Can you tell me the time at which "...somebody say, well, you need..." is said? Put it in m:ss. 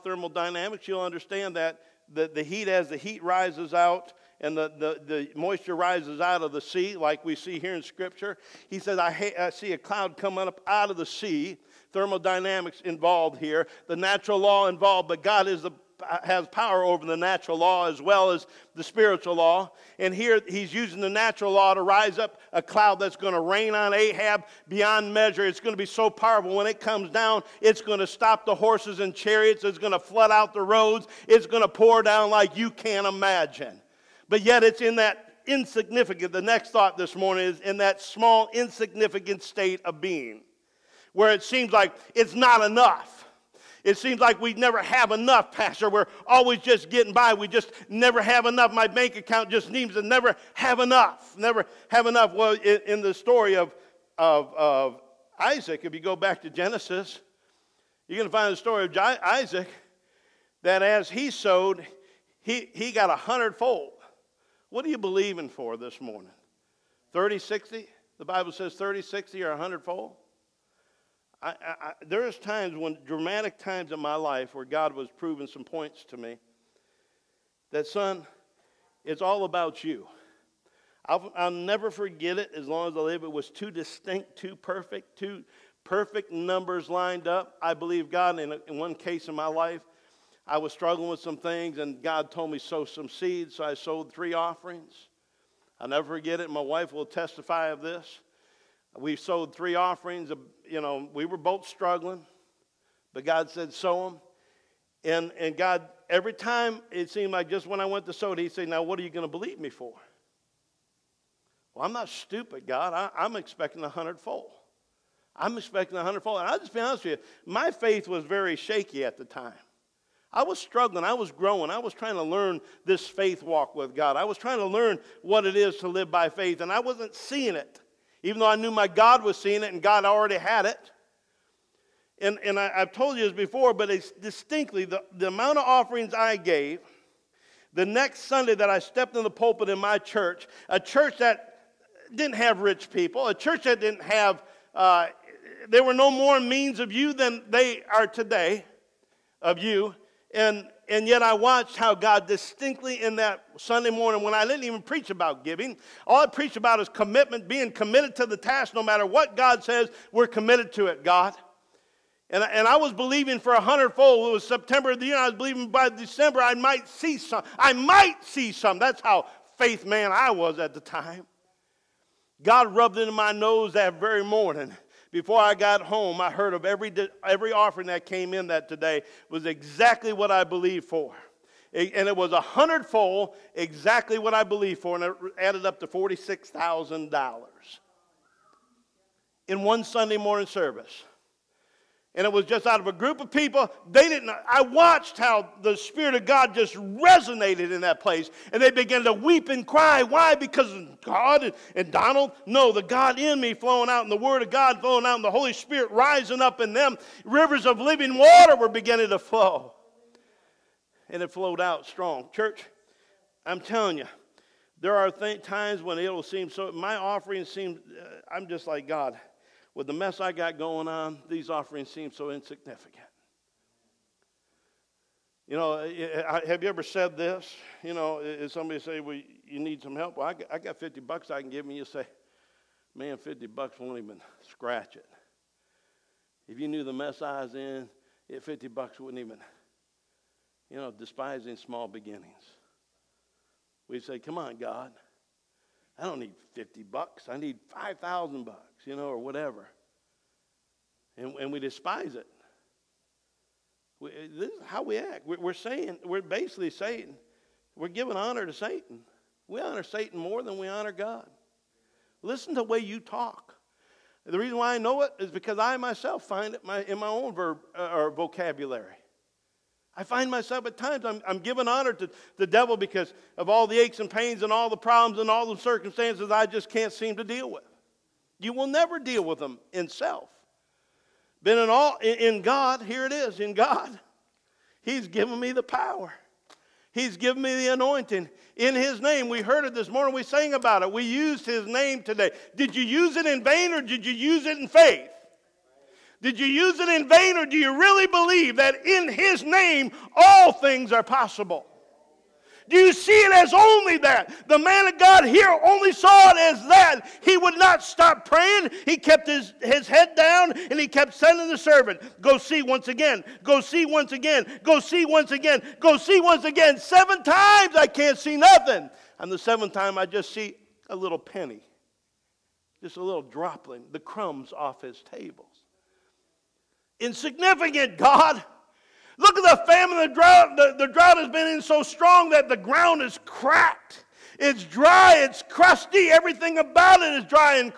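3:48.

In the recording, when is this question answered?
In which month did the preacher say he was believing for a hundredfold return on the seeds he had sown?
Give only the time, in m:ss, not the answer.
2:44.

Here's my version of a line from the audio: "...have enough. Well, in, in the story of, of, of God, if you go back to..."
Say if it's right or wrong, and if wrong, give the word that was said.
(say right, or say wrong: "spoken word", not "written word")
wrong: "Isaac", not "God".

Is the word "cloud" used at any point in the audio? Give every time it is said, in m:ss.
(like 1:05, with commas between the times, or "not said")
0:09, 0:22.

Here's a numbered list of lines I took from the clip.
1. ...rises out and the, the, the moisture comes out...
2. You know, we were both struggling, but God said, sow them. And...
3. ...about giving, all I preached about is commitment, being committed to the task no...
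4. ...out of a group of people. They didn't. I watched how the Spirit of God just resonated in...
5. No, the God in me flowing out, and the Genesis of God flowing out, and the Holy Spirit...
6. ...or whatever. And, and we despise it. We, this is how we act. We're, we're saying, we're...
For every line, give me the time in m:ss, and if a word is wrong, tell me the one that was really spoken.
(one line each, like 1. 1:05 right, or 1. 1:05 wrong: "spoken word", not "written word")
1. 0:03 wrong: "rises", not "comes"
2. 1:40 right
3. 2:35 right
4. 3:12 right
5. 3:22 wrong: "Word", not "Genesis"
6. 4:09 right.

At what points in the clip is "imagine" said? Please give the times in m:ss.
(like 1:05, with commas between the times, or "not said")
0:33.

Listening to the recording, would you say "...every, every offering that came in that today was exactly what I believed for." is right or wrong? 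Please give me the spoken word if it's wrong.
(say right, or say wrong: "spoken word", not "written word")
right.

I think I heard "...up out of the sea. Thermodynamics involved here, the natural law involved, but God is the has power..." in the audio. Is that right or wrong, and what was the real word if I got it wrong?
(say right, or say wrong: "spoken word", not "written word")
right.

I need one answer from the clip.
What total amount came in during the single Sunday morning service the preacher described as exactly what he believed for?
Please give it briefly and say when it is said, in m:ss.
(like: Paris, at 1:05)
$46,000, at 3:05.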